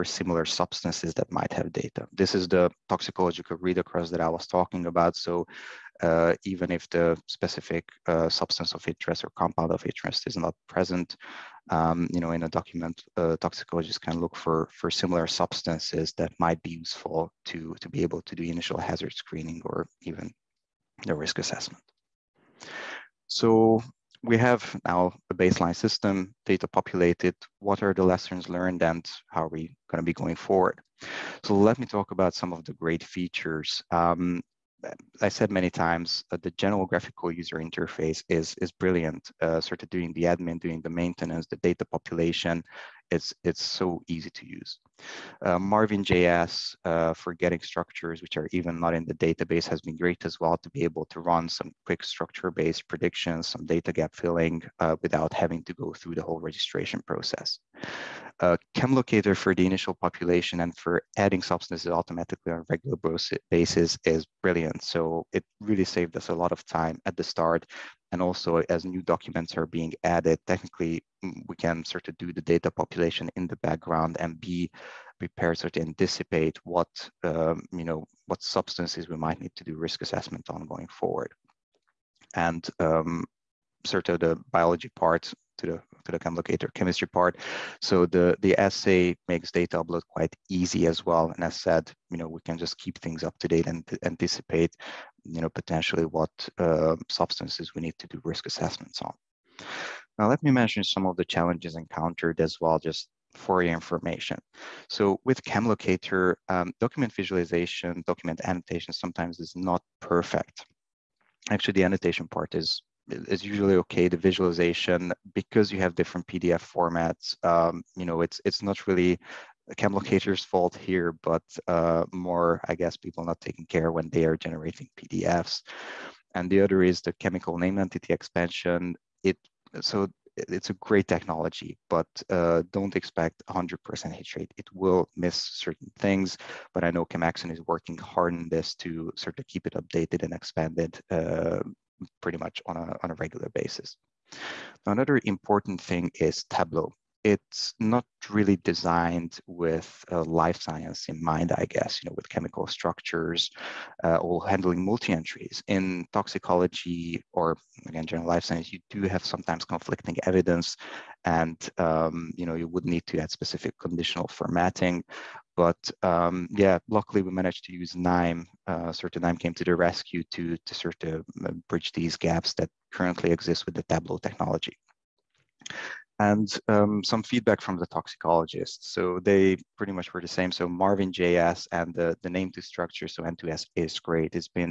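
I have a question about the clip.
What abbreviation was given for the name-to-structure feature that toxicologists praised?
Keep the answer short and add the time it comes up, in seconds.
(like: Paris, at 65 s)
N2S, at 183 s.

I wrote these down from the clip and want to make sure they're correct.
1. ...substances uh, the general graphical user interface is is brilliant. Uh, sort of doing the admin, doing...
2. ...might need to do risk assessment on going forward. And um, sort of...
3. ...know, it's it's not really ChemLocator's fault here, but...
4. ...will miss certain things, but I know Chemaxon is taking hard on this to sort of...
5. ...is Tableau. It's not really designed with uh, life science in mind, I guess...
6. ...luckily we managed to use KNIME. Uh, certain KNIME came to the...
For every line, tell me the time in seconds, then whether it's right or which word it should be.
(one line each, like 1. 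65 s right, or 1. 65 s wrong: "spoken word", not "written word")
1. 35 s wrong: "times", not "substances"
2. 79 s right
3. 118 s right
4. 134 s wrong: "working", not "taking"
5. 146 s right
6. 166 s right.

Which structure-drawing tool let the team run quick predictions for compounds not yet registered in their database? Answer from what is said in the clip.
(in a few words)
Marvin.js.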